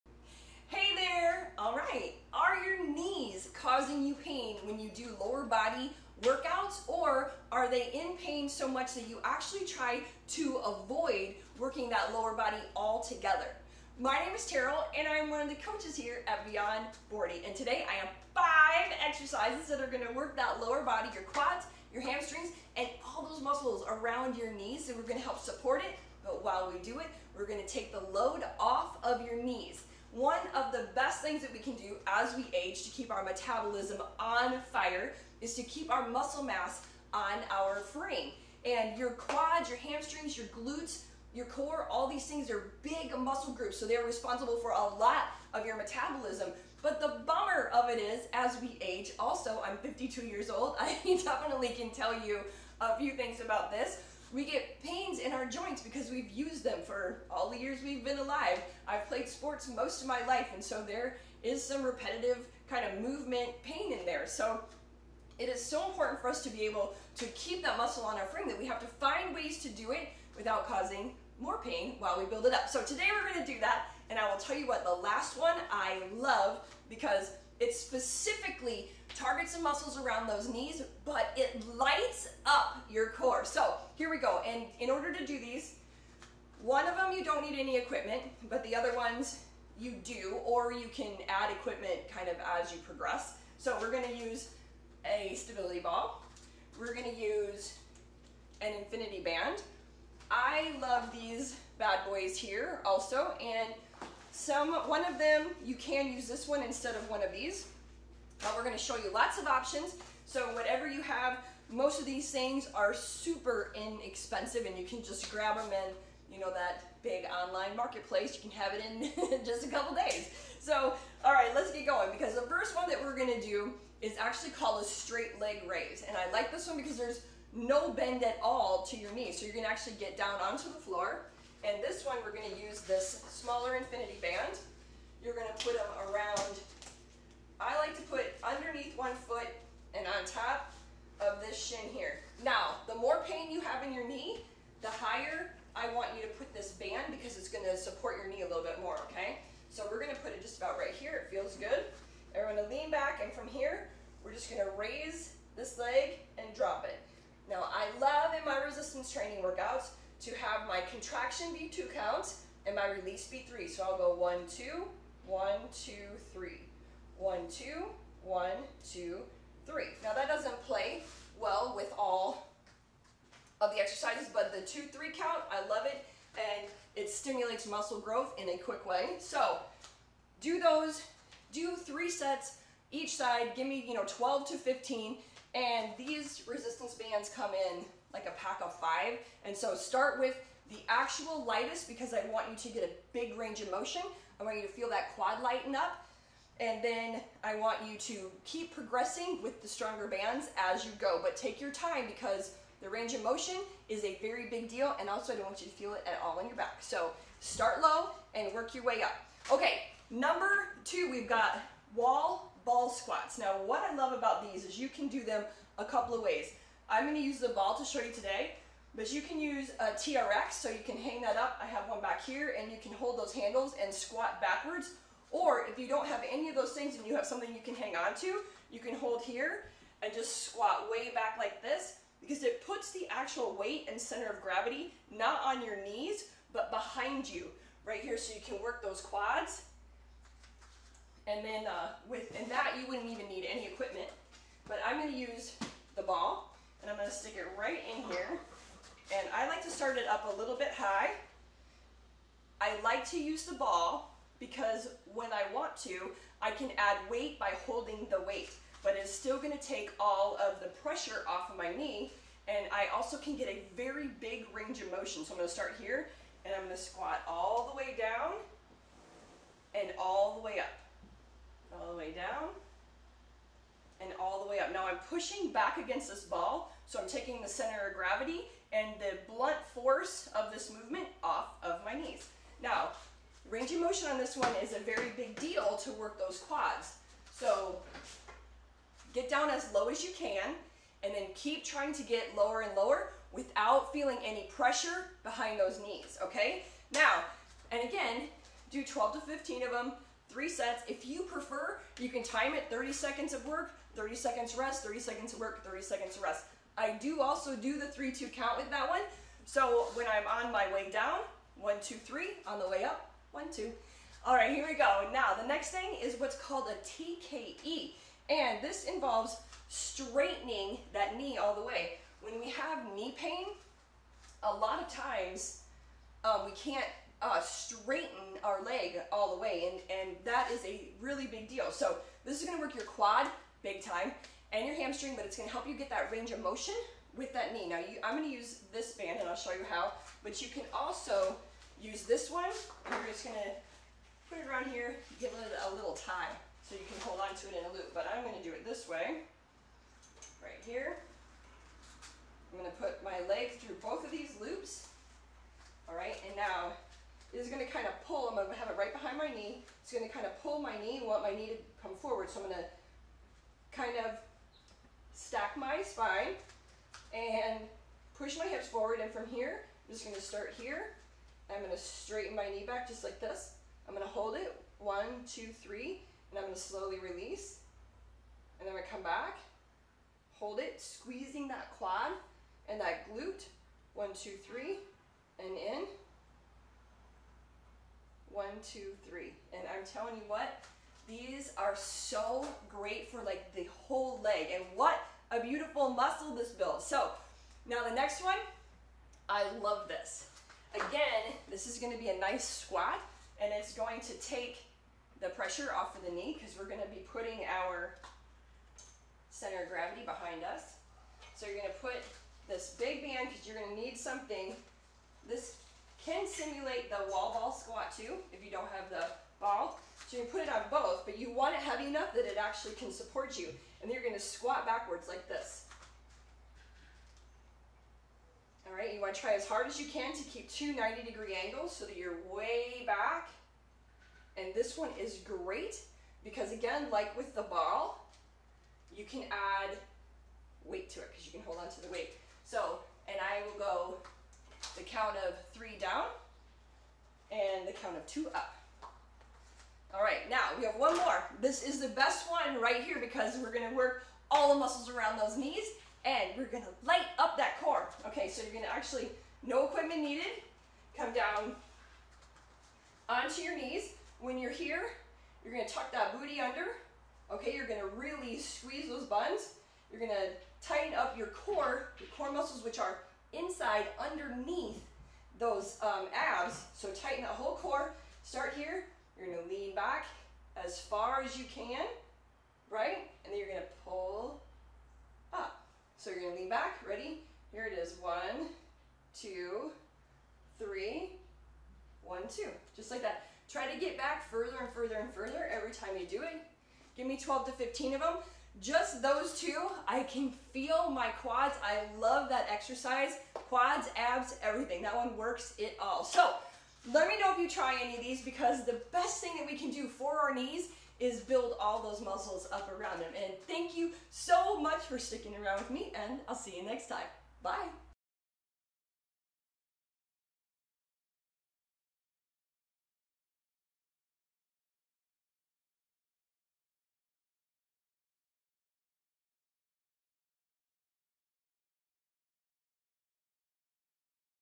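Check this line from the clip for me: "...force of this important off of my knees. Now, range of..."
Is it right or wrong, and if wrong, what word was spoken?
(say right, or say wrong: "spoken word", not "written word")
wrong: "movement", not "important".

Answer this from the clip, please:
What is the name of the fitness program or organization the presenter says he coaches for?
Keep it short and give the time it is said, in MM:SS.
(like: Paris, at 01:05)
Beyond 40, at 00:16.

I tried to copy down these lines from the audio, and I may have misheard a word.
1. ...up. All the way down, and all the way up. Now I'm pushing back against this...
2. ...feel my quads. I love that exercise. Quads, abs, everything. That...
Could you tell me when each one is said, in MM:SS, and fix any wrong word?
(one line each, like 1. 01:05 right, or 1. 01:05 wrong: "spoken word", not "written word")
1. 04:30 right
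2. 08:20 right.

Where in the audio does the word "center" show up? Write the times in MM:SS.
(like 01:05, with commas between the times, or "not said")
03:53, 04:37, 06:49.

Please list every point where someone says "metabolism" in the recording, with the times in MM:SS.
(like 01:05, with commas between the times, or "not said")
00:33, 00:45.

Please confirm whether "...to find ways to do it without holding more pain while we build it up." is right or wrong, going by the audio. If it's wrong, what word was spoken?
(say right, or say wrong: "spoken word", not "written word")
wrong: "causing", not "holding".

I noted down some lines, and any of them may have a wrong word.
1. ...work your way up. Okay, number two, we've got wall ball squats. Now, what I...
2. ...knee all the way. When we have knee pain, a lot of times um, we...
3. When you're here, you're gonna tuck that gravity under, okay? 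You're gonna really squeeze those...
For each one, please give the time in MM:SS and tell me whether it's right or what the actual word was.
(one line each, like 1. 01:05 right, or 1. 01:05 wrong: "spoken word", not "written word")
1. 03:28 right
2. 05:21 right
3. 07:44 wrong: "booty", not "gravity".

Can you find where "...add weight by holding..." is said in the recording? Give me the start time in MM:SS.
04:16.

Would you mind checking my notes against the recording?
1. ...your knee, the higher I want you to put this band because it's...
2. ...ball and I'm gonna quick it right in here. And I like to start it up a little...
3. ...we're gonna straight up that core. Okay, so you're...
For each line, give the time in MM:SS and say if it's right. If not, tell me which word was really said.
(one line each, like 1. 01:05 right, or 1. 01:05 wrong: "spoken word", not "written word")
1. 02:23 right
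2. 04:06 wrong: "stick", not "quick"
3. 07:36 wrong: "light", not "straight".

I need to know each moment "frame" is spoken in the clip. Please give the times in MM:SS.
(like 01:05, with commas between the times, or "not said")
00:37, 01:08.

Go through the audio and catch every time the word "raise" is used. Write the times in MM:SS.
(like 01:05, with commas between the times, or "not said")
02:05, 02:34.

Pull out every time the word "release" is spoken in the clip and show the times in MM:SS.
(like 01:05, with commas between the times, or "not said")
02:42, 06:16.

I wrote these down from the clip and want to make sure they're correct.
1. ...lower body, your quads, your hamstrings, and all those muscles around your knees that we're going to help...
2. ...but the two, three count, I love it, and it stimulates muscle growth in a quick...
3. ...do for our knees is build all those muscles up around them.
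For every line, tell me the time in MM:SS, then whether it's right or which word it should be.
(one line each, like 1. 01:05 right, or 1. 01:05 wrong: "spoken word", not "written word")
1. 00:20 right
2. 02:54 right
3. 08:29 right.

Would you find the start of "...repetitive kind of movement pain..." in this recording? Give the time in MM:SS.
01:01.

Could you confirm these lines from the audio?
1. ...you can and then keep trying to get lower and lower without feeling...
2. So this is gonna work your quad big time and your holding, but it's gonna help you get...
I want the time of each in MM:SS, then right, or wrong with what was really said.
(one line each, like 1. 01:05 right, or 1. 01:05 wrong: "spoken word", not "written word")
1. 04:50 right
2. 05:31 wrong: "hamstring", not "holding".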